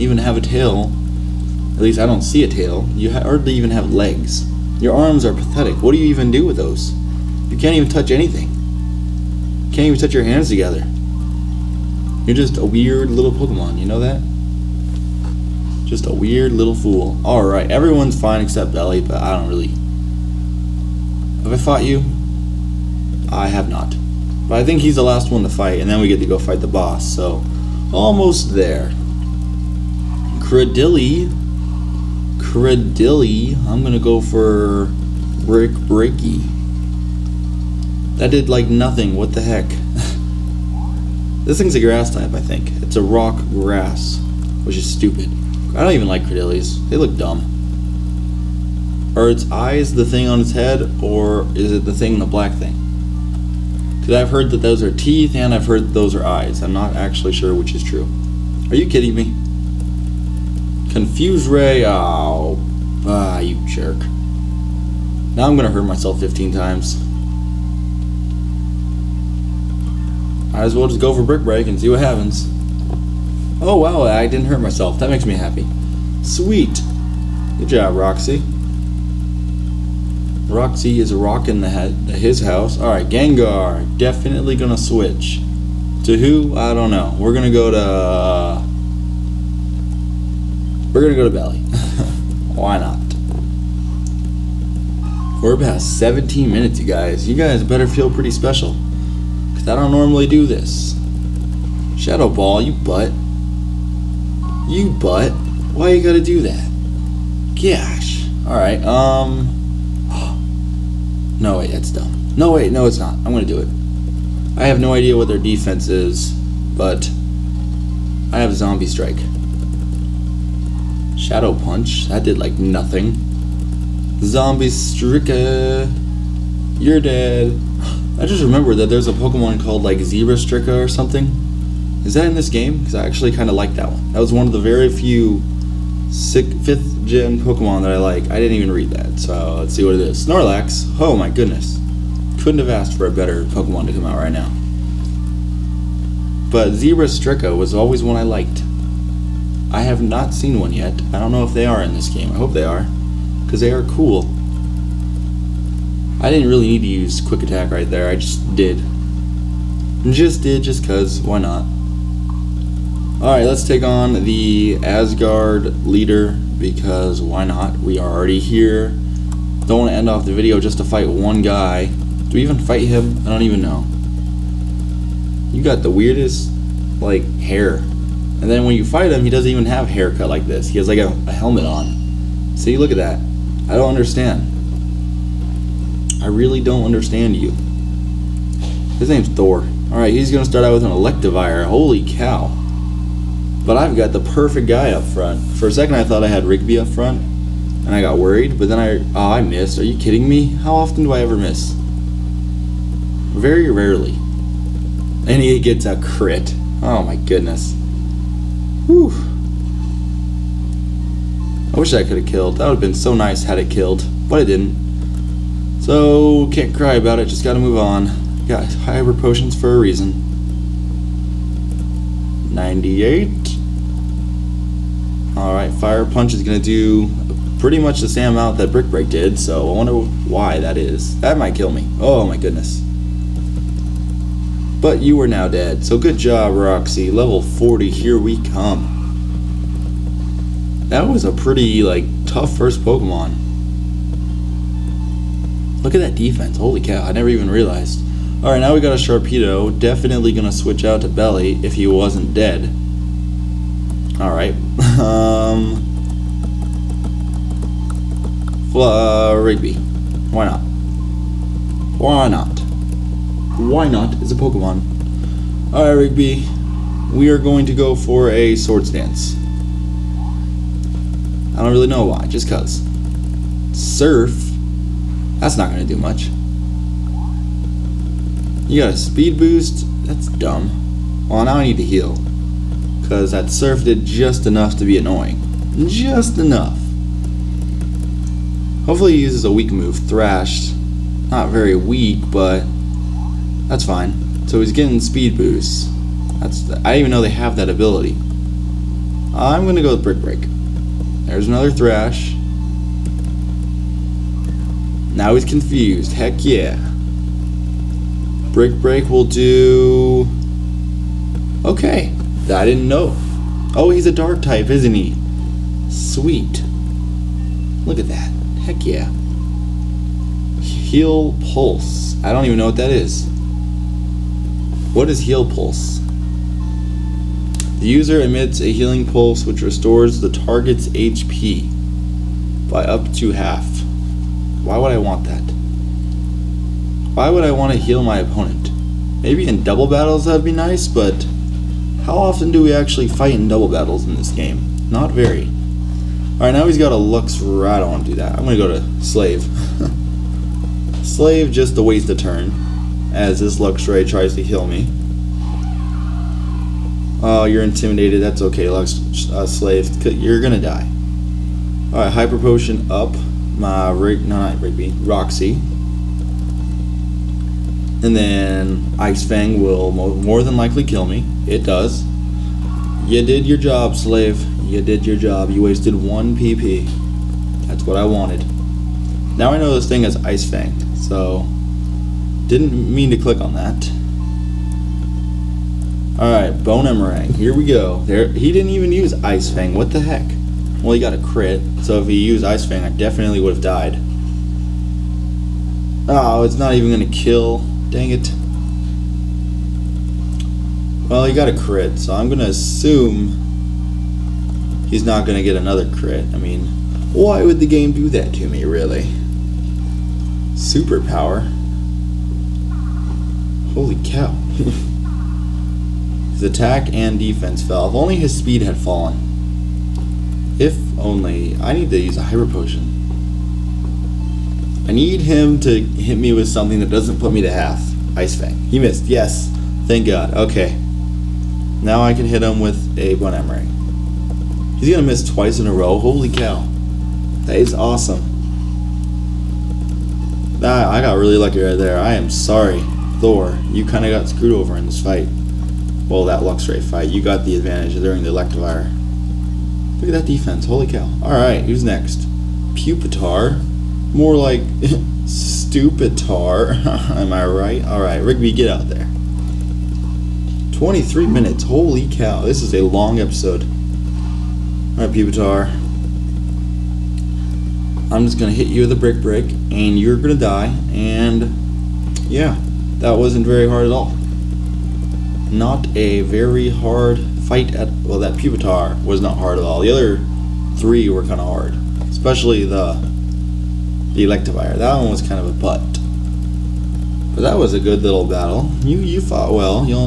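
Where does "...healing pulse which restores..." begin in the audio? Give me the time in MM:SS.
05:28.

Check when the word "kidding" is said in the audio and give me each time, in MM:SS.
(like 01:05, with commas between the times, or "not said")
00:58, 03:19.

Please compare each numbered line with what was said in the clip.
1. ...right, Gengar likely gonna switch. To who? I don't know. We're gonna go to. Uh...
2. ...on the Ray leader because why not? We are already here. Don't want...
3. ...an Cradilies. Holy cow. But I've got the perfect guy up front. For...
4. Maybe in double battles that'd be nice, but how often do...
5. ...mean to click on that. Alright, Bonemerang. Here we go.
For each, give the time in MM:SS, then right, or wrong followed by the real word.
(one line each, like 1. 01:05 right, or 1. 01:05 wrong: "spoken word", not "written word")
1. 01:22 wrong: "definitely", not "likely"
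2. 02:43 wrong: "Asgard", not "Ray"
3. 03:10 wrong: "Electivire", not "Cradilies"
4. 05:39 right
5. 06:22 right.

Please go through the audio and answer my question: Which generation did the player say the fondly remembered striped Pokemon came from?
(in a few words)
fifth.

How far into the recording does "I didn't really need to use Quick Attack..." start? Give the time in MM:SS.
02:36.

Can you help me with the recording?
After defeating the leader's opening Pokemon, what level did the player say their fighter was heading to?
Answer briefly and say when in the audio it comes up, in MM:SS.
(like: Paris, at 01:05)
40, at 03:57.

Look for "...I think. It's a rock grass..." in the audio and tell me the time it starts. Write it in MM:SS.
00:42.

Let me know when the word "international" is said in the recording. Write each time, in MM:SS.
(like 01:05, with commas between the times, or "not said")
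not said.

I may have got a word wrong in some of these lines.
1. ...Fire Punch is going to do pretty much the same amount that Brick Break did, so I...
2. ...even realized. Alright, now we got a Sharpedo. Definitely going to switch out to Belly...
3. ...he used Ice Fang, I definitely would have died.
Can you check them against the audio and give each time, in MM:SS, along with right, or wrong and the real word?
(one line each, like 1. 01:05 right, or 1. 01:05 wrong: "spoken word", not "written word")
1. 03:45 right
2. 04:07 right
3. 06:32 right.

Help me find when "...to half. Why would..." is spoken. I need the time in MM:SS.
05:33.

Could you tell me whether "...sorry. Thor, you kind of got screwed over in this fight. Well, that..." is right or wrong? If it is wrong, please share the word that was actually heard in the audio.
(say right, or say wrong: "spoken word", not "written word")
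right.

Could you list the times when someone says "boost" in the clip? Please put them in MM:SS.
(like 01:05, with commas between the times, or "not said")
04:39, 04:55.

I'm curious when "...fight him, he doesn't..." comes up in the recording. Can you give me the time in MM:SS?
02:58.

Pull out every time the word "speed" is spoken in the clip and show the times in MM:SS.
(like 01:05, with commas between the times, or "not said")
04:38, 04:55, 06:58.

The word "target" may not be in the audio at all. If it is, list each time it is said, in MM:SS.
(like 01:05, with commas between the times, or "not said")
05:30.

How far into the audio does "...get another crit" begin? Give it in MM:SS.
06:45.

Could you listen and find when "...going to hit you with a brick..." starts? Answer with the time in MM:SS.
07:48.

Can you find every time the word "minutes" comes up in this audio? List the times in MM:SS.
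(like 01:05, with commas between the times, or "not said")
01:36, 07:41.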